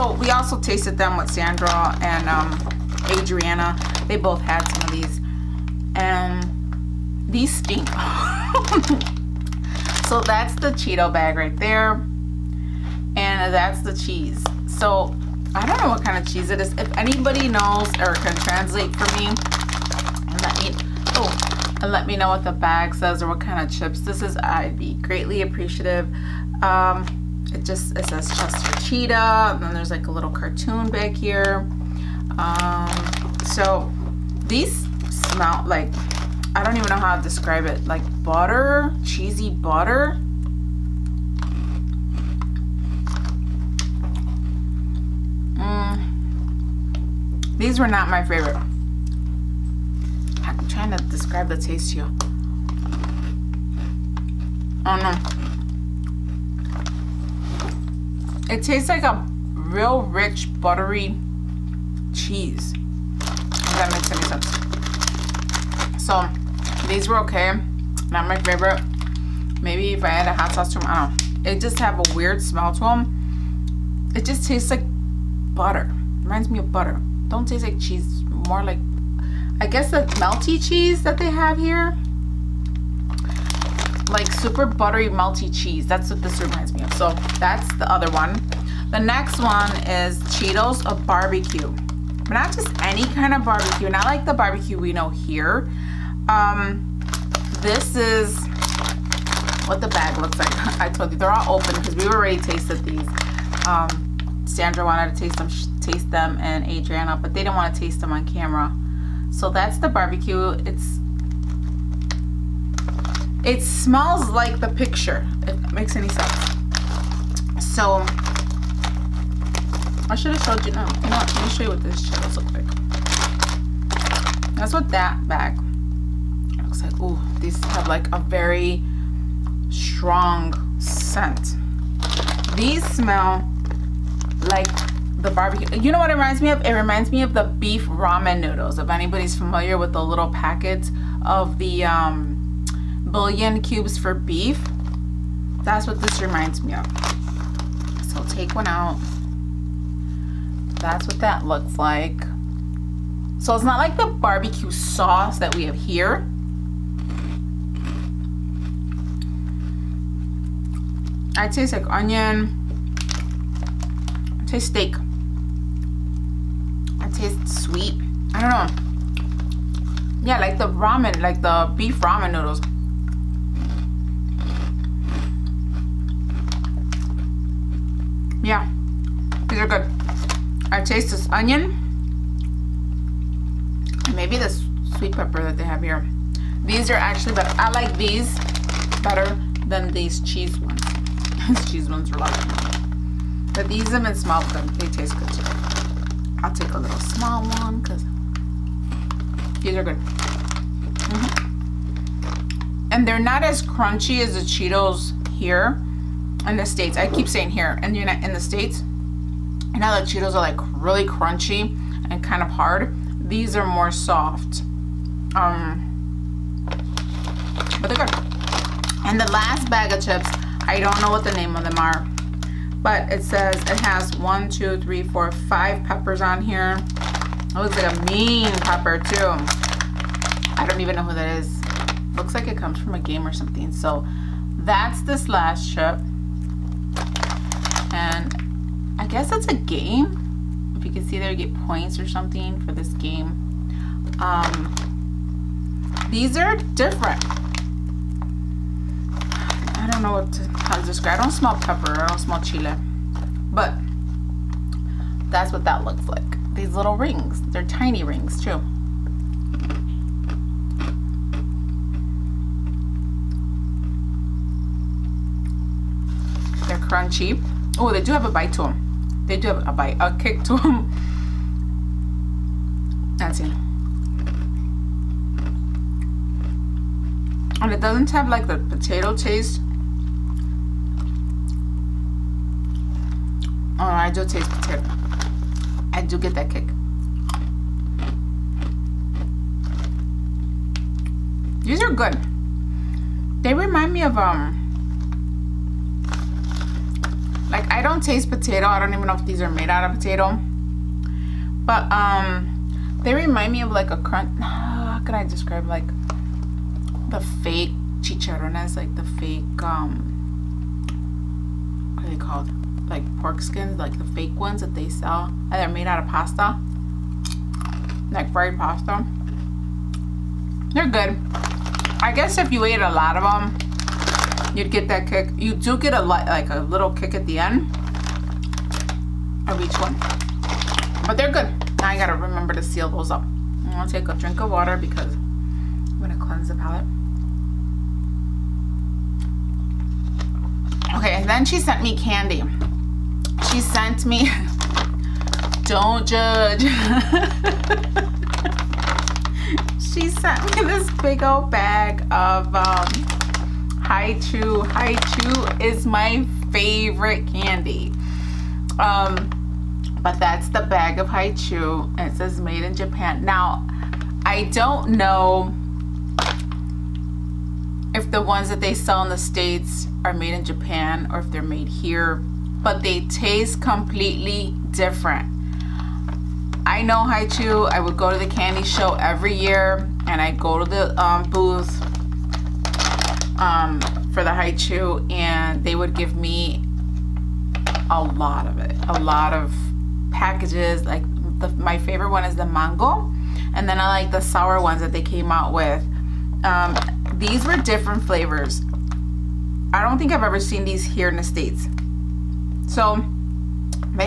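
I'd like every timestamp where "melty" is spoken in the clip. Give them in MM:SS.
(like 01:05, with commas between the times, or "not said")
01:20, 01:25.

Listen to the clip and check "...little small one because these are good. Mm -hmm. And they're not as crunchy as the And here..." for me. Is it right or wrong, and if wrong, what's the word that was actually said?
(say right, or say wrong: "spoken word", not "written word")
wrong: "Cheetos", not "And".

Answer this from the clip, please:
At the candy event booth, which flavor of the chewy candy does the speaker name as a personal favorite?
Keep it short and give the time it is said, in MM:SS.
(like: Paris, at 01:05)
mango, at 06:32.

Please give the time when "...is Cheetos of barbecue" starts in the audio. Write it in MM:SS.
01:29.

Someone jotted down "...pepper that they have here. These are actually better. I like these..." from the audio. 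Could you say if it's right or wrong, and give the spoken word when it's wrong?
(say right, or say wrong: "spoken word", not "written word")
right.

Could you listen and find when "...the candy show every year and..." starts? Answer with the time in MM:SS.
06:18.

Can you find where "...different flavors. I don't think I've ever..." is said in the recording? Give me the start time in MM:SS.
06:37.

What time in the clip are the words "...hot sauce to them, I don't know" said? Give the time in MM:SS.
01:10.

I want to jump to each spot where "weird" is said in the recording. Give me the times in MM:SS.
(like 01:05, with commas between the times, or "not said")
01:12.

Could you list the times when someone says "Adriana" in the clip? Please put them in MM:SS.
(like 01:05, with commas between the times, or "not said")
00:03, 01:46.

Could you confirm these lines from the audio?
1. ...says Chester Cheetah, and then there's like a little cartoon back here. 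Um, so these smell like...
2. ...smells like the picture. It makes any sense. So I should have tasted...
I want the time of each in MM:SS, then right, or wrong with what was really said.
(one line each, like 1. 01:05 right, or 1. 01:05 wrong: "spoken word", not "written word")
1. 00:28 right
2. 01:53 wrong: "showed", not "tasted".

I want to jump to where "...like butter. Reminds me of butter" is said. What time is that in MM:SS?
01:14.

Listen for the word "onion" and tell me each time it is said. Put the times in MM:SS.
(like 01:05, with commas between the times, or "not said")
02:41, 03:01.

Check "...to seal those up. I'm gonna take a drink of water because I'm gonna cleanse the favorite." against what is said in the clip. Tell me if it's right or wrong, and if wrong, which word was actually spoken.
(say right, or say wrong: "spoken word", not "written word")
wrong: "palate", not "favorite".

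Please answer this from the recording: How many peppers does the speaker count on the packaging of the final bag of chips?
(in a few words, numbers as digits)
5.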